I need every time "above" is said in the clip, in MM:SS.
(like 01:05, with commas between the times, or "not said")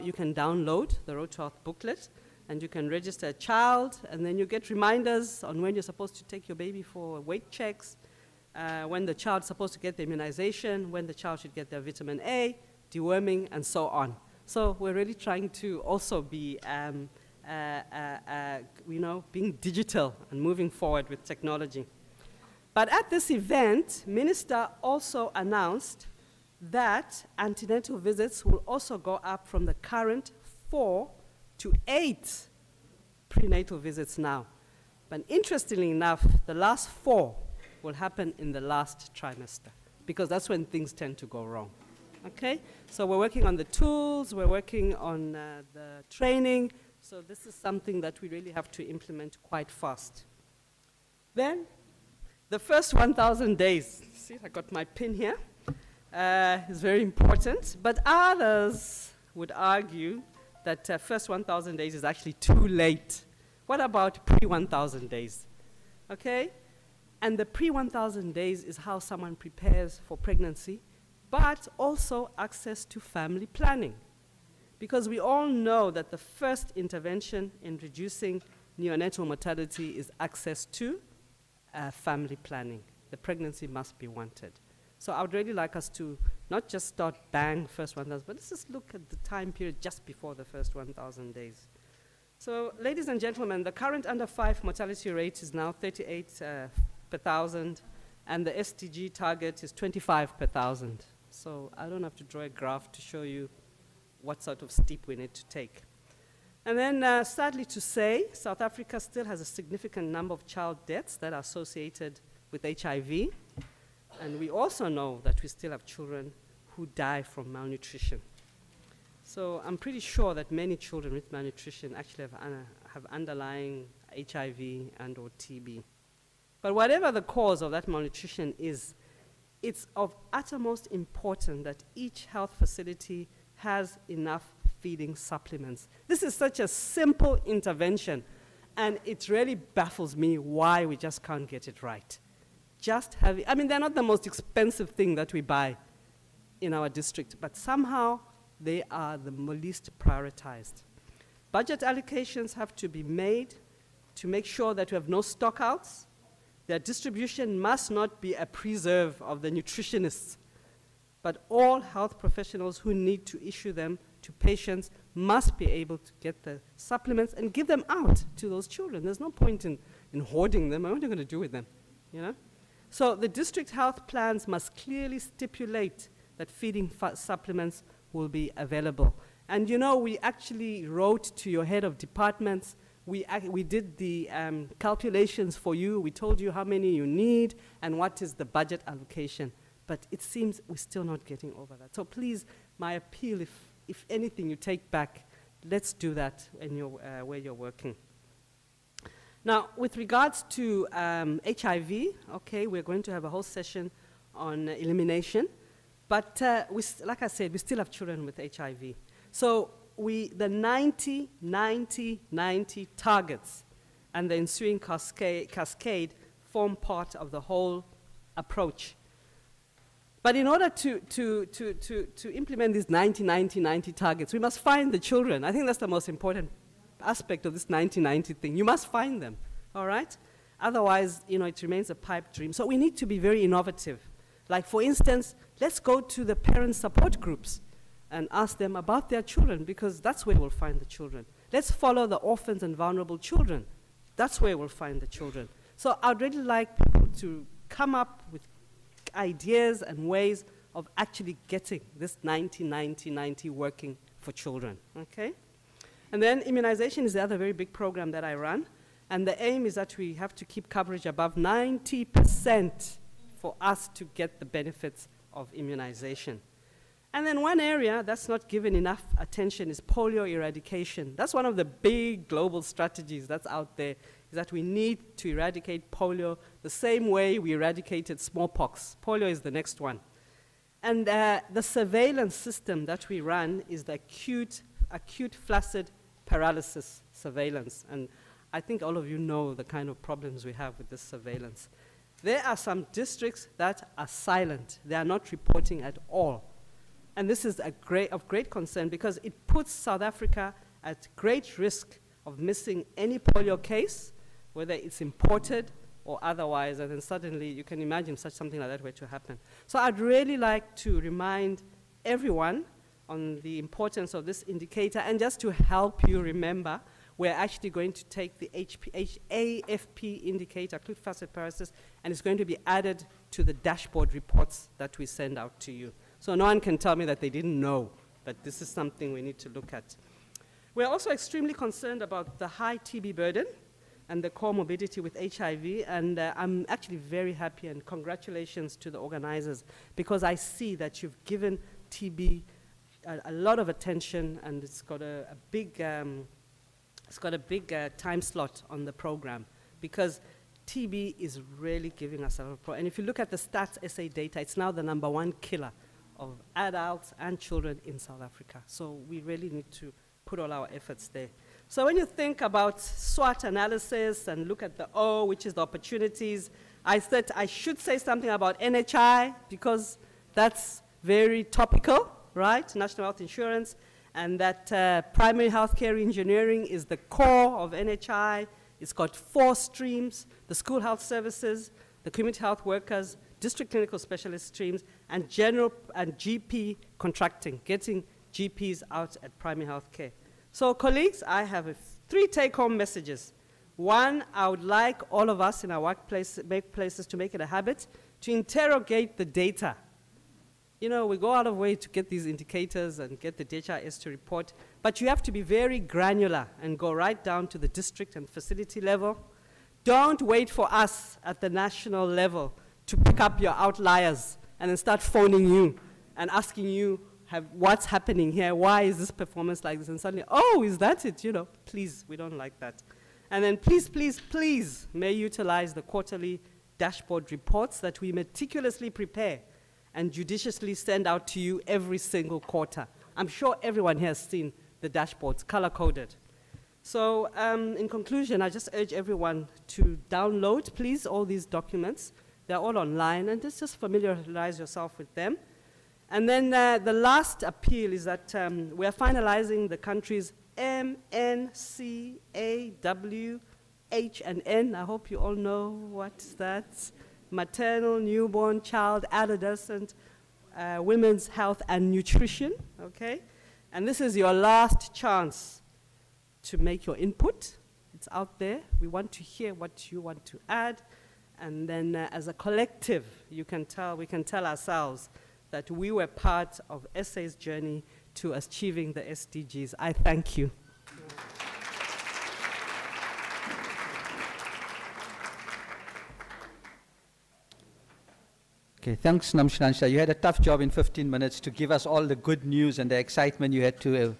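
04:21.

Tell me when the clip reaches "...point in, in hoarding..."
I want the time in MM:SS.
02:49.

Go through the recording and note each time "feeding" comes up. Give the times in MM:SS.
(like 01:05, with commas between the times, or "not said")
02:14, 02:56.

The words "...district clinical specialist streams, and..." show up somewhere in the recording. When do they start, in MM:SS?
06:23.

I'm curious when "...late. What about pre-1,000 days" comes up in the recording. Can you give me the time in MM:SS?
01:02.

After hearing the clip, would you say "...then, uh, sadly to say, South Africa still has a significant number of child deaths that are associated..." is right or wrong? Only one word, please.
right.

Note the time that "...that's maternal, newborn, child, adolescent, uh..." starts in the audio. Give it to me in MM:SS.
07:36.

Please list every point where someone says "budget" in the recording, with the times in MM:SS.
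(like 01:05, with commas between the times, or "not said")
02:31, 03:08.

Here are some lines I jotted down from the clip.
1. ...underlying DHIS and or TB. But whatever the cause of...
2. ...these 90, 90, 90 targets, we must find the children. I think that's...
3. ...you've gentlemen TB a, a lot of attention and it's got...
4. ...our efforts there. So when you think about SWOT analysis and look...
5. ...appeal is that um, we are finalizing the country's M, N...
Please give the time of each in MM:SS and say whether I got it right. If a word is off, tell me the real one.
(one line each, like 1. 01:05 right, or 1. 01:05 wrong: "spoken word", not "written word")
1. 02:03 wrong: "HIV", not "DHIS"
2. 03:42 right
3. 05:41 wrong: "given", not "gentlemen"
4. 06:00 right
5. 07:27 right.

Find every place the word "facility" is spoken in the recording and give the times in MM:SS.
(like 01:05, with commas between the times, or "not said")
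02:12, 06:48.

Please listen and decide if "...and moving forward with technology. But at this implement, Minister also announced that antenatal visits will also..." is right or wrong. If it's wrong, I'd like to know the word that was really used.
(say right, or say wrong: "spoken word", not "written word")
wrong: "event", not "implement".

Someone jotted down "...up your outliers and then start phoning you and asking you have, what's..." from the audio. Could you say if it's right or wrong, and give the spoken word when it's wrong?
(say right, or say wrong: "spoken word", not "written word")
right.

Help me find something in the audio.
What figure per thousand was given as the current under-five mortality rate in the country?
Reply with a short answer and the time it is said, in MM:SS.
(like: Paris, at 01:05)
38 per thousand, at 01:35.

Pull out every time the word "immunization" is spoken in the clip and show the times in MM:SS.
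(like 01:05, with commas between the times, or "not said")
00:10, 04:16, 04:25.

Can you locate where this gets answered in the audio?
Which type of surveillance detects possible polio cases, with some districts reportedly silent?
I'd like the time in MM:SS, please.
04:44.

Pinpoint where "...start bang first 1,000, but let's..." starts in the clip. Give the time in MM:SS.
01:26.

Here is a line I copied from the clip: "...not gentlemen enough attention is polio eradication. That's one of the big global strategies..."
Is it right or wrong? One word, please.
wrong.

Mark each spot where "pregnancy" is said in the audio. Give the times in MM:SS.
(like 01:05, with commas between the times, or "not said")
01:10, 01:23.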